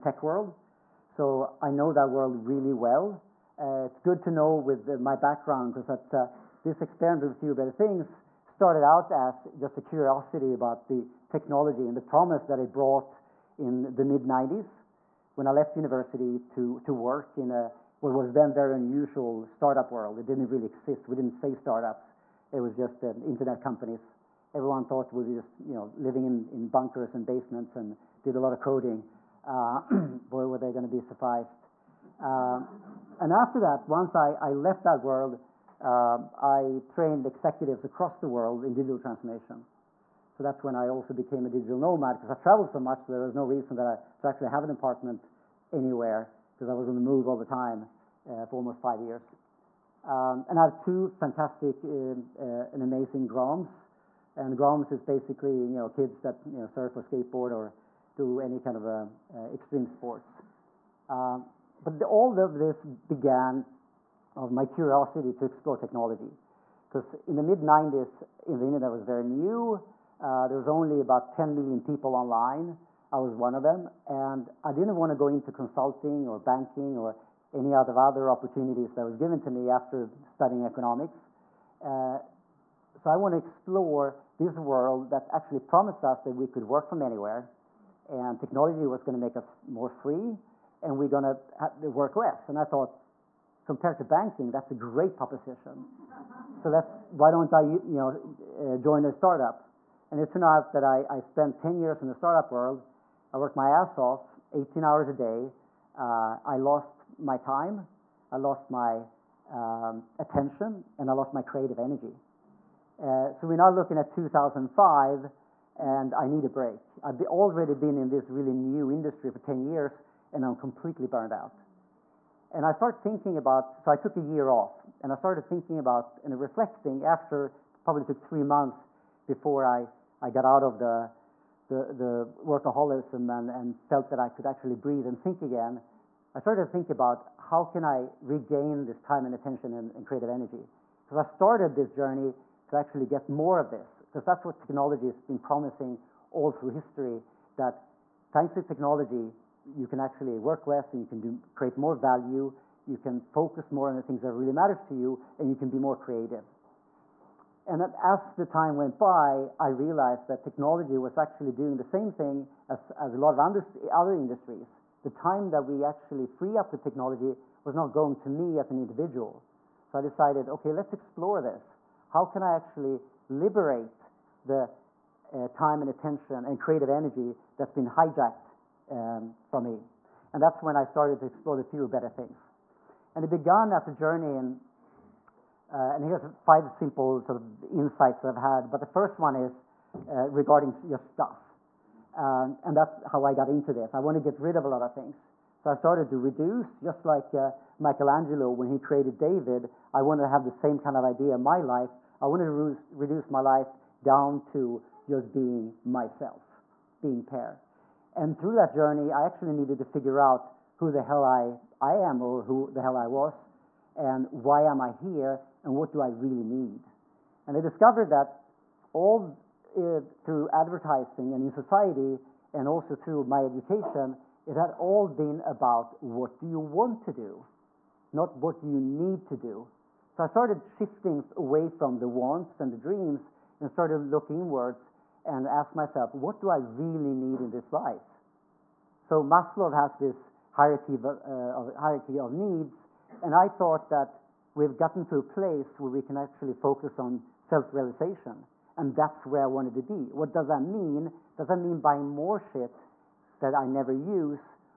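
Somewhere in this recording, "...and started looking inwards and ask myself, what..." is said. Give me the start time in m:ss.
3:53.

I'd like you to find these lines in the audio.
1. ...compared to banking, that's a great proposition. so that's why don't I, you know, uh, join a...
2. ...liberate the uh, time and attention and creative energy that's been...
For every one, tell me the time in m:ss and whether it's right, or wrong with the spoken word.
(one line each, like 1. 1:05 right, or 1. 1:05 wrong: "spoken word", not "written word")
1. 1:33 right
2. 2:53 right.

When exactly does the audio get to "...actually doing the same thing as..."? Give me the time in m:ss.
2:41.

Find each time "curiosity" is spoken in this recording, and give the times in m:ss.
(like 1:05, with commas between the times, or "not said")
0:09, 1:04.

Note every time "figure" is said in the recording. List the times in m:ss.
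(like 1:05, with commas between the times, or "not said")
3:29.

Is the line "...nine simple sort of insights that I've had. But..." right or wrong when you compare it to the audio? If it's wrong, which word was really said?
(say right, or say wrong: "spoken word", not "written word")
wrong: "five", not "nine".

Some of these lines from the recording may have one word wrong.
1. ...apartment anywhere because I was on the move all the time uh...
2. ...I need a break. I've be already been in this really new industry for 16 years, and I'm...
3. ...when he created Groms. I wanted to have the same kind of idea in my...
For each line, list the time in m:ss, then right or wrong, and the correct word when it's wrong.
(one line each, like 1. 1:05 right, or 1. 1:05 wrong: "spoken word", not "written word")
1. 0:44 right
2. 1:56 wrong: "10", not "16"
3. 3:18 wrong: "David", not "Groms".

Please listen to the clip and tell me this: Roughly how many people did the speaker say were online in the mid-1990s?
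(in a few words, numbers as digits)
10 million.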